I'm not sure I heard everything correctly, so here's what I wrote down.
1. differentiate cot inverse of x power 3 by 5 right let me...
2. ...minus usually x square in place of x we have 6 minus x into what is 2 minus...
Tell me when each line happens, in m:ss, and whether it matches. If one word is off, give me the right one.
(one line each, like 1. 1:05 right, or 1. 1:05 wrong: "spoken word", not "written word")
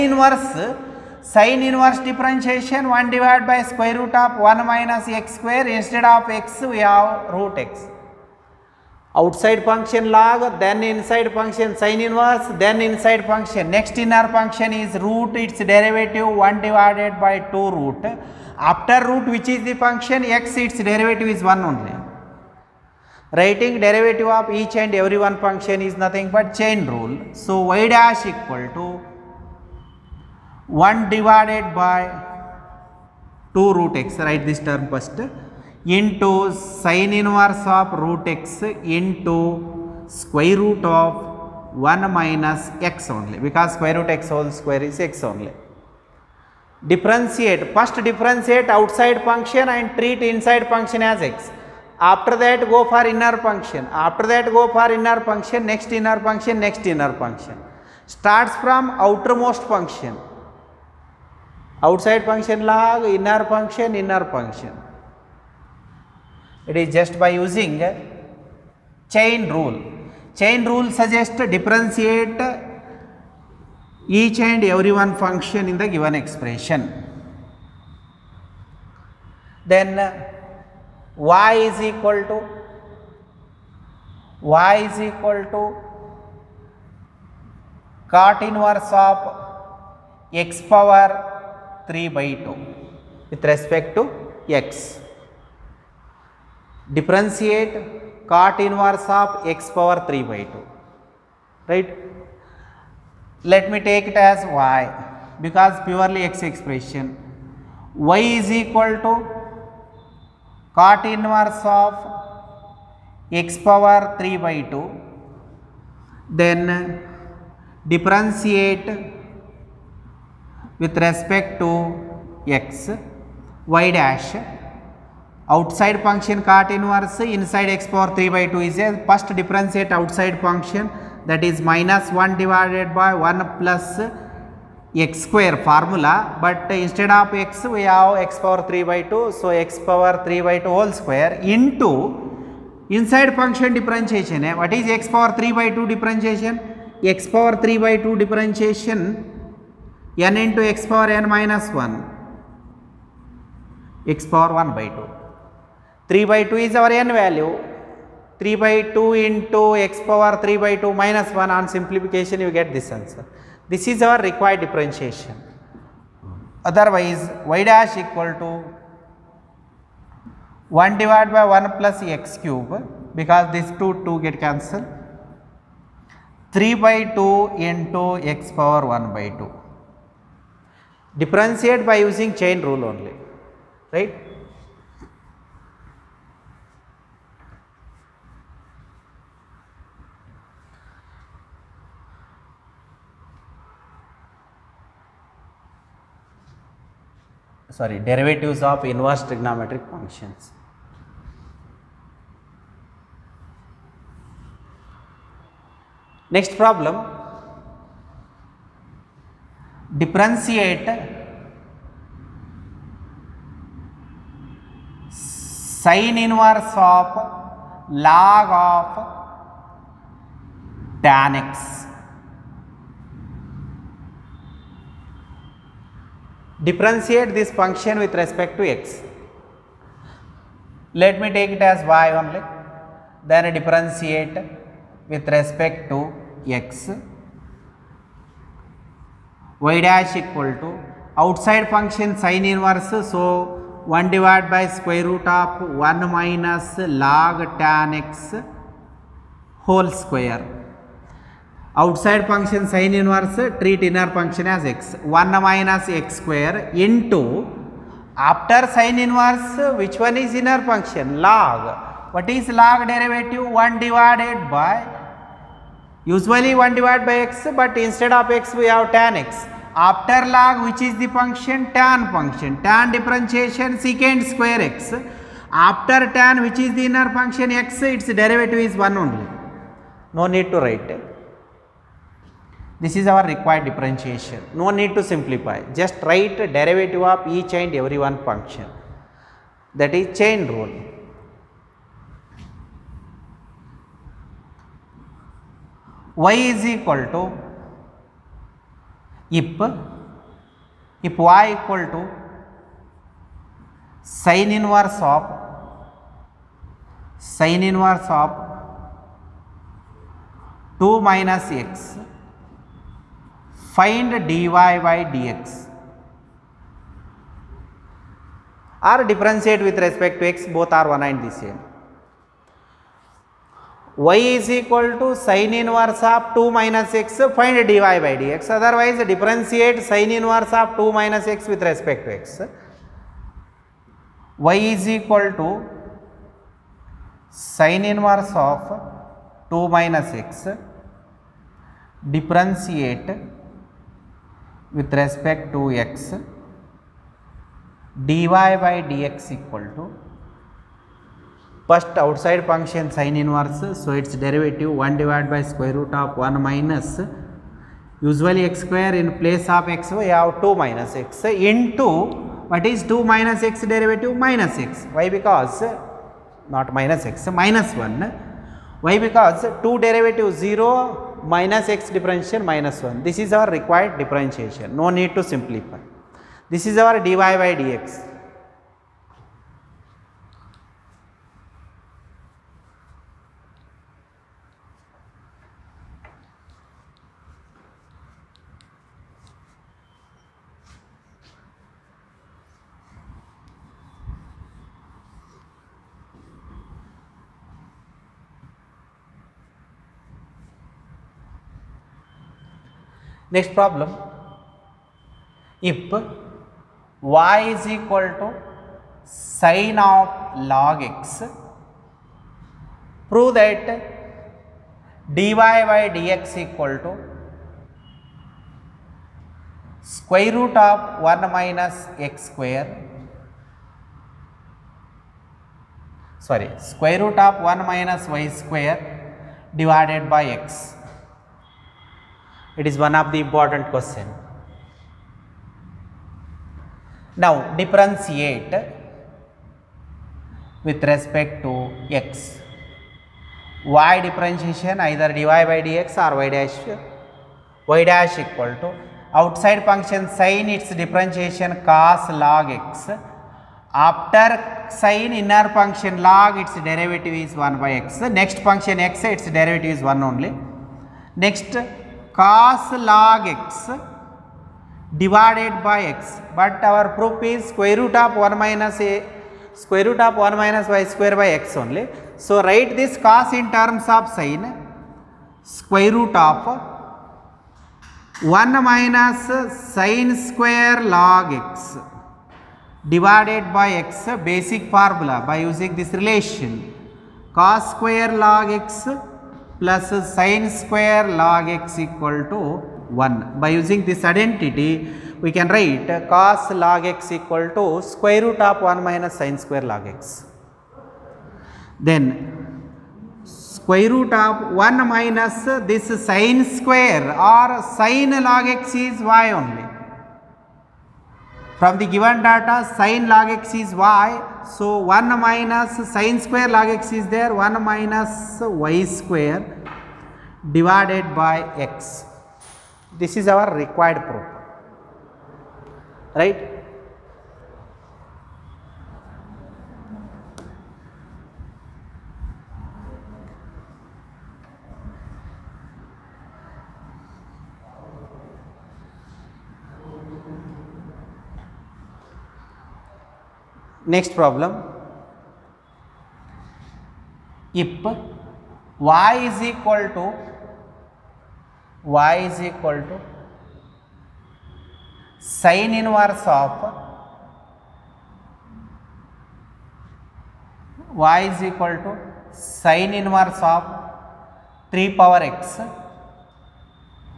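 1. 1:36 wrong: "2", not "5"
2. 5:56 wrong: "2", not "6".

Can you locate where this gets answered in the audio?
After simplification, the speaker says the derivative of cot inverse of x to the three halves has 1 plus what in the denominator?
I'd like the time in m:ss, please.
2:51.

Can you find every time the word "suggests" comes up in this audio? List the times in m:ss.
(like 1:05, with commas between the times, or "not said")
1:10.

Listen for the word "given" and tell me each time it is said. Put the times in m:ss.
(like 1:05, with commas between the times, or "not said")
1:15, 8:31.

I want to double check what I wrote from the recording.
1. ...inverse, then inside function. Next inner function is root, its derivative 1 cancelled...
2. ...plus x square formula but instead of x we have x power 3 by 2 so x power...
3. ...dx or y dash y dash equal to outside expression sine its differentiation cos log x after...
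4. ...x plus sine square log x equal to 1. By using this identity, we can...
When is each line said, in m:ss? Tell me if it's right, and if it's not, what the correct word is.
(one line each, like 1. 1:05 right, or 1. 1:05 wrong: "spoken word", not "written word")
1. 0:12 wrong: "divided", not "cancelled"
2. 2:13 right
3. 7:25 wrong: "function", not "expression"
4. 8:08 right.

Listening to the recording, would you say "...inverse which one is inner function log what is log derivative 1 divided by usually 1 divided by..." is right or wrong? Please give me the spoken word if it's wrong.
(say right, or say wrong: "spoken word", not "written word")
right.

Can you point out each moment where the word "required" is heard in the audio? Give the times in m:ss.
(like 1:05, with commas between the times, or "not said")
2:44, 4:43, 6:13, 8:43.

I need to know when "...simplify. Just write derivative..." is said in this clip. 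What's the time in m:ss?
4:45.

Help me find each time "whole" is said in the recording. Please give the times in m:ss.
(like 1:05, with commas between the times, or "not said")
2:20, 4:09.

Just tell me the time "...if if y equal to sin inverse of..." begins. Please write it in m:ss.
4:59.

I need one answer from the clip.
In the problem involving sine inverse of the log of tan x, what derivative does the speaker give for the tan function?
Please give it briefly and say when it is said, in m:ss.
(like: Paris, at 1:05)
secant square x, at 4:33.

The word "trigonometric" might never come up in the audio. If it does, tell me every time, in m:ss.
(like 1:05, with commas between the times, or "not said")
3:19.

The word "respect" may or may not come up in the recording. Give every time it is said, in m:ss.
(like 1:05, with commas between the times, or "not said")
1:33, 2:01, 3:48, 3:55, 5:19, 5:31, 5:44, 7:20.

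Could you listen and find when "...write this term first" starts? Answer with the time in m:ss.
0:34.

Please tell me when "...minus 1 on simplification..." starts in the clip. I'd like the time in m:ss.
2:41.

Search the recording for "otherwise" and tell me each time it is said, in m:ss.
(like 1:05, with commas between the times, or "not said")
2:46, 5:28.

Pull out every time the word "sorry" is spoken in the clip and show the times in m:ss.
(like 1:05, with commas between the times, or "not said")
3:17.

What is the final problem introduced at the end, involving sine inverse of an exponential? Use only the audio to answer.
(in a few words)
sin inverse of 3 power x.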